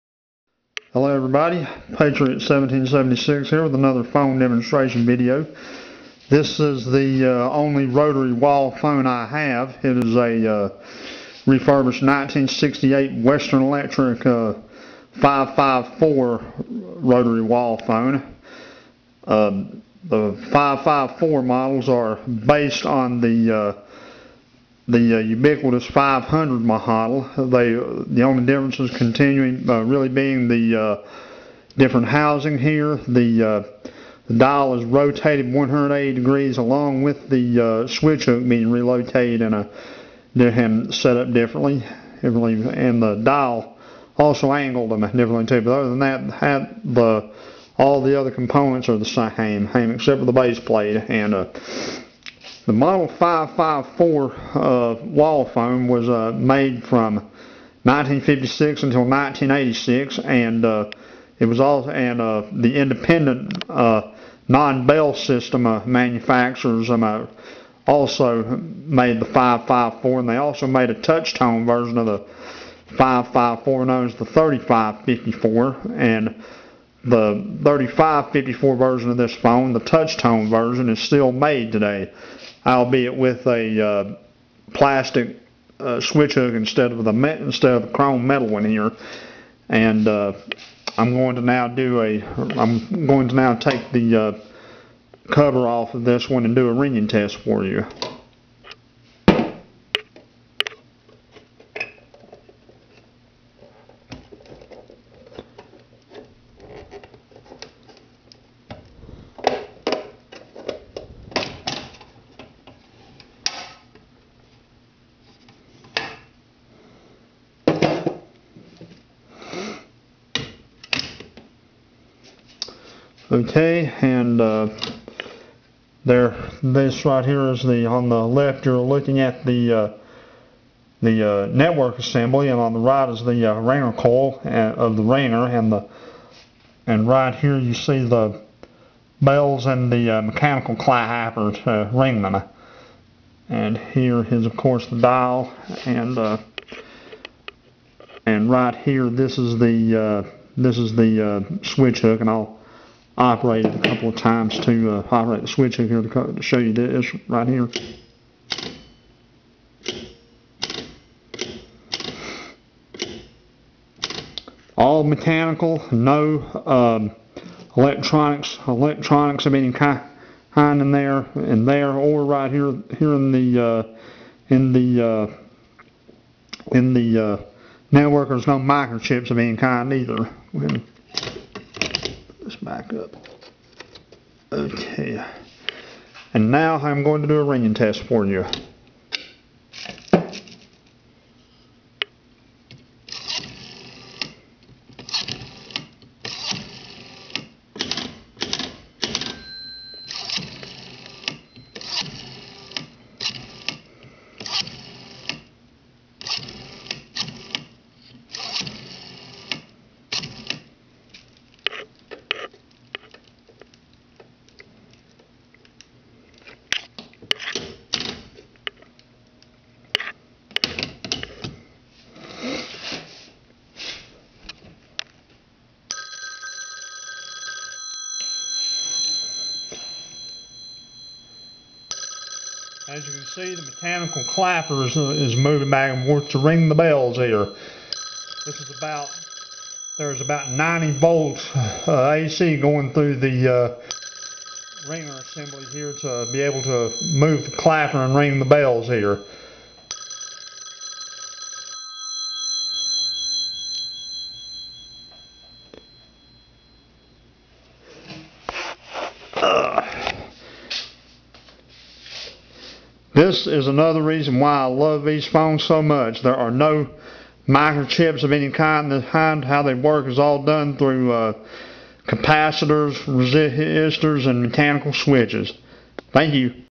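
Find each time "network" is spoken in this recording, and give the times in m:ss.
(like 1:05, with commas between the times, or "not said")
2:11, 2:57.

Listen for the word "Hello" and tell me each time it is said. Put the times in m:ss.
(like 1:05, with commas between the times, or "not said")
0:00.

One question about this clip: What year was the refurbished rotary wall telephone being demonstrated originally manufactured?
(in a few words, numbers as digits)
1968.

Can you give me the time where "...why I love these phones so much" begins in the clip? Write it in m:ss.
4:24.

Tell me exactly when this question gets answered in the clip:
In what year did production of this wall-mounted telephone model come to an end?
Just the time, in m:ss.
0:59.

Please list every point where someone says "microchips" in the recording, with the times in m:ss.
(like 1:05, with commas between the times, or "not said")
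2:58, 4:27.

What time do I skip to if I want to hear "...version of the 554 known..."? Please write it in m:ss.
1:11.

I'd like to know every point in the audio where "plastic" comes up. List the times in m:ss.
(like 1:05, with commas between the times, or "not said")
1:24.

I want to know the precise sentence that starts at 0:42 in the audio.
And the dial also angled them differently too.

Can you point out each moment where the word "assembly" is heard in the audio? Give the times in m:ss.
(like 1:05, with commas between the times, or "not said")
2:11, 4:05.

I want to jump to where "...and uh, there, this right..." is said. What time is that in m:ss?
2:04.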